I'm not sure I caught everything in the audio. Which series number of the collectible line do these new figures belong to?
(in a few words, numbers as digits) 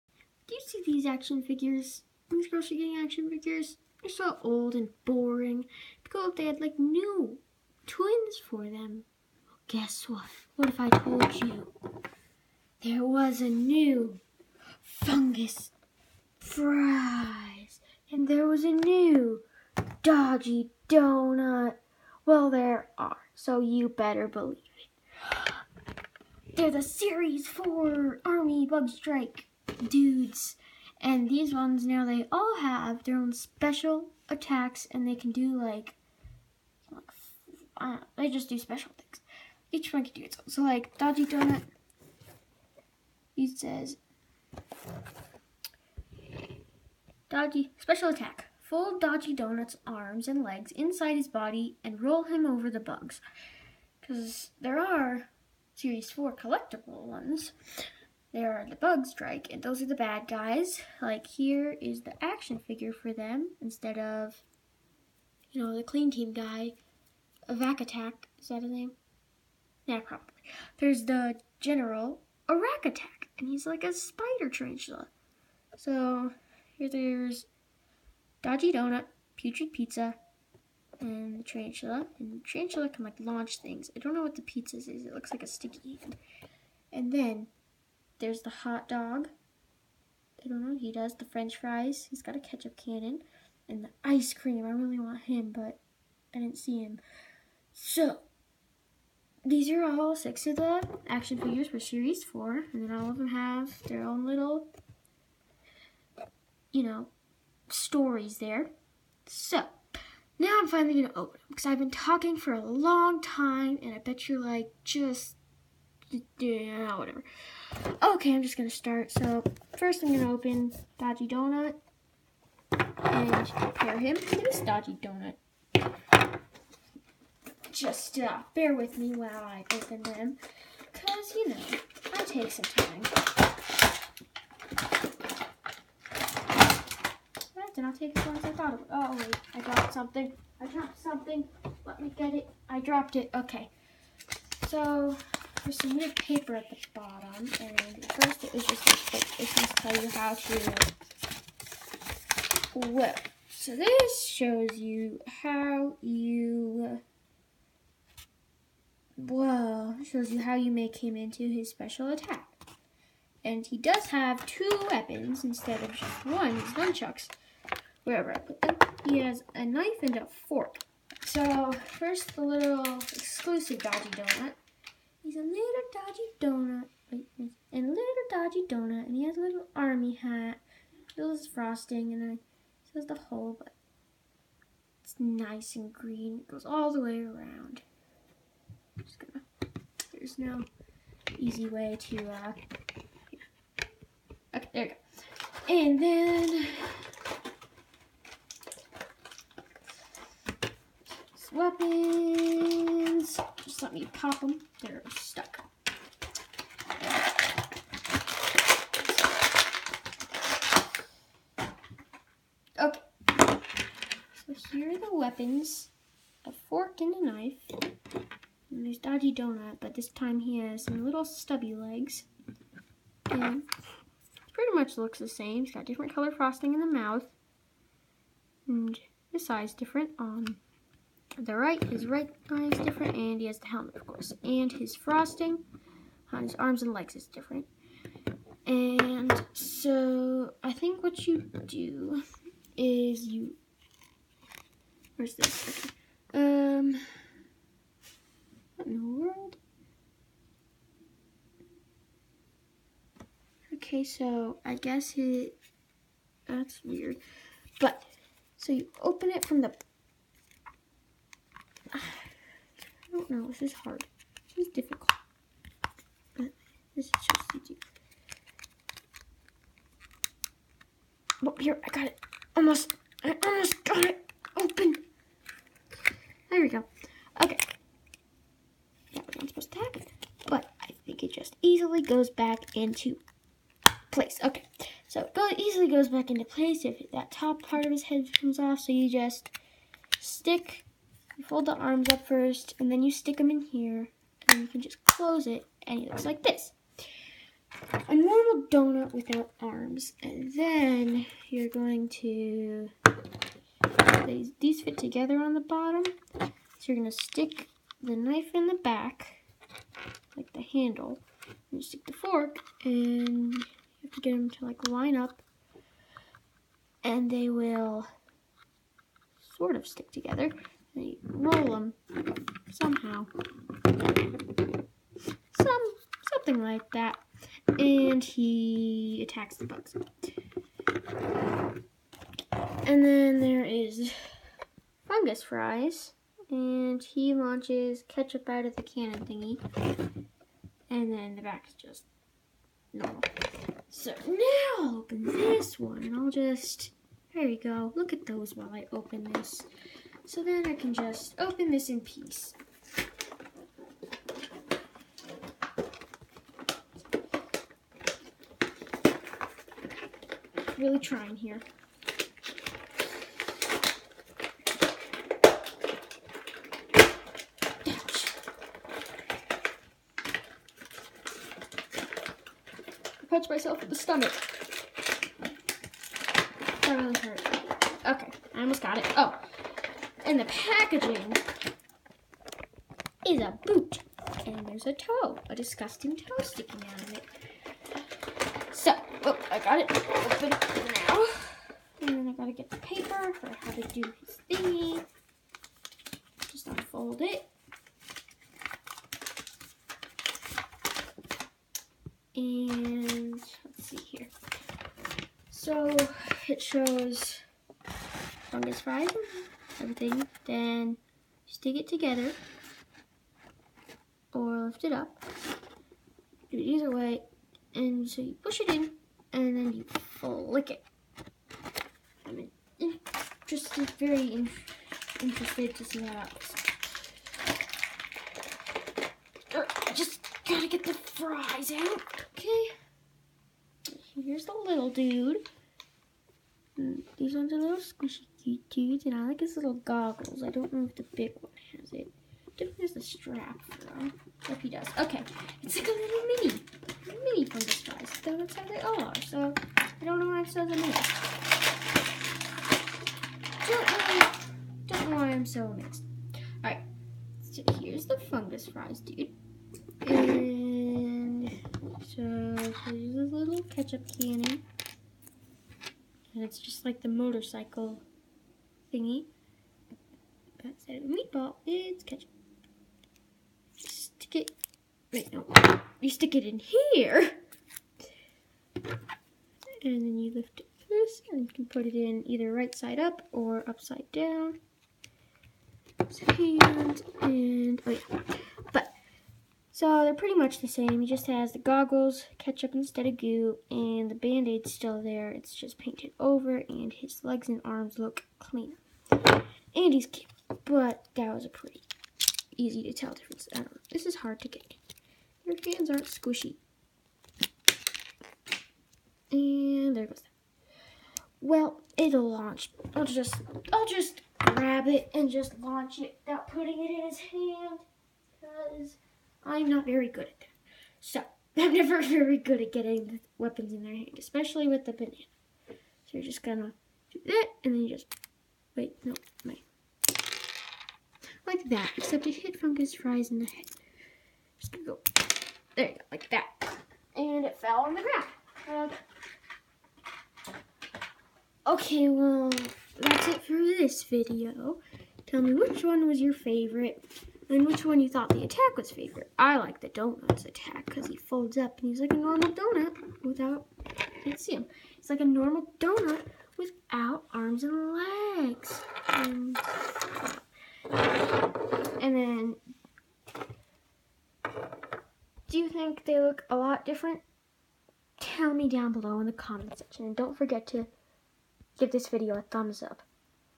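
4.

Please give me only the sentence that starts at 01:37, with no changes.
So, these are all six of the action figures for Series 4.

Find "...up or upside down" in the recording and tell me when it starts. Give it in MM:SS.
08:02.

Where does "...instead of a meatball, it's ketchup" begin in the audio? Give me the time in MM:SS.
07:50.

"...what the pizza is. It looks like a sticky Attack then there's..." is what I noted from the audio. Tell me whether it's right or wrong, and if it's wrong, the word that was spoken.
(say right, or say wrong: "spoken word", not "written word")
wrong: "And", not "Attack".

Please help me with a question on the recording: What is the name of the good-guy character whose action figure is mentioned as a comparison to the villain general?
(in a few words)
Vac Attack.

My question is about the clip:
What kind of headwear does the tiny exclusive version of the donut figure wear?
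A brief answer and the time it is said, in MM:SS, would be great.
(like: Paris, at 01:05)
Army hat, at 02:59.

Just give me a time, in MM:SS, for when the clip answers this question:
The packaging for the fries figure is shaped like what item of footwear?
06:23.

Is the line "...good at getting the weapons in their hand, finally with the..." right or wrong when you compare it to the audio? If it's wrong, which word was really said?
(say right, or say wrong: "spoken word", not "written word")
wrong: "especially", not "finally".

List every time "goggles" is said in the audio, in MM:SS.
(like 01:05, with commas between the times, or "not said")
07:19, 08:11.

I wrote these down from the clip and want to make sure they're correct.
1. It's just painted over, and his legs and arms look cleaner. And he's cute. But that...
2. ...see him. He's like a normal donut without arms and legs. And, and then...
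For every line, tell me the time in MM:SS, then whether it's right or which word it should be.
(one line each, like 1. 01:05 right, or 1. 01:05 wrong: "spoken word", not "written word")
1. 08:15 right
2. 09:14 right.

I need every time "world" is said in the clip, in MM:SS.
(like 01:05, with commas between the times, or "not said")
04:09.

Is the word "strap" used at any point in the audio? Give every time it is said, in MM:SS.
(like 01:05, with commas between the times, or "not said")
07:23.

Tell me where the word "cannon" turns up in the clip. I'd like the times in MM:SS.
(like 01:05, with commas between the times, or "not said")
01:32, 05:38, 07:44.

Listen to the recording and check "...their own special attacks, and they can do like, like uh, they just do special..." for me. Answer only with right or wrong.
right.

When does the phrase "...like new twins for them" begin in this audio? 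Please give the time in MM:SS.
00:06.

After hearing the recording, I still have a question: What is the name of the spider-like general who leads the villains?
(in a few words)
Arac Attack.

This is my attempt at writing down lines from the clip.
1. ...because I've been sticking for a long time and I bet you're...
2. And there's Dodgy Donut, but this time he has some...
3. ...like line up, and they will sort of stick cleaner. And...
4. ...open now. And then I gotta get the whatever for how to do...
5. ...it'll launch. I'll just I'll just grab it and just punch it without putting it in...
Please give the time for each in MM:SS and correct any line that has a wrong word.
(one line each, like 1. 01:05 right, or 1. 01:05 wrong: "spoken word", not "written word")
1. 01:51 wrong: "talking", not "sticking"
2. 03:38 right
3. 05:14 wrong: "together", not "cleaner"
4. 06:29 wrong: "paper", not "whatever"
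5. 08:31 wrong: "launch", not "punch".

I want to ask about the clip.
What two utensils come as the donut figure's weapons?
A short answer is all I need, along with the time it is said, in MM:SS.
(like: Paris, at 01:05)
A knife and a fork, at 02:49.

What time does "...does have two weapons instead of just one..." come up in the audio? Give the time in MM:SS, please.
02:43.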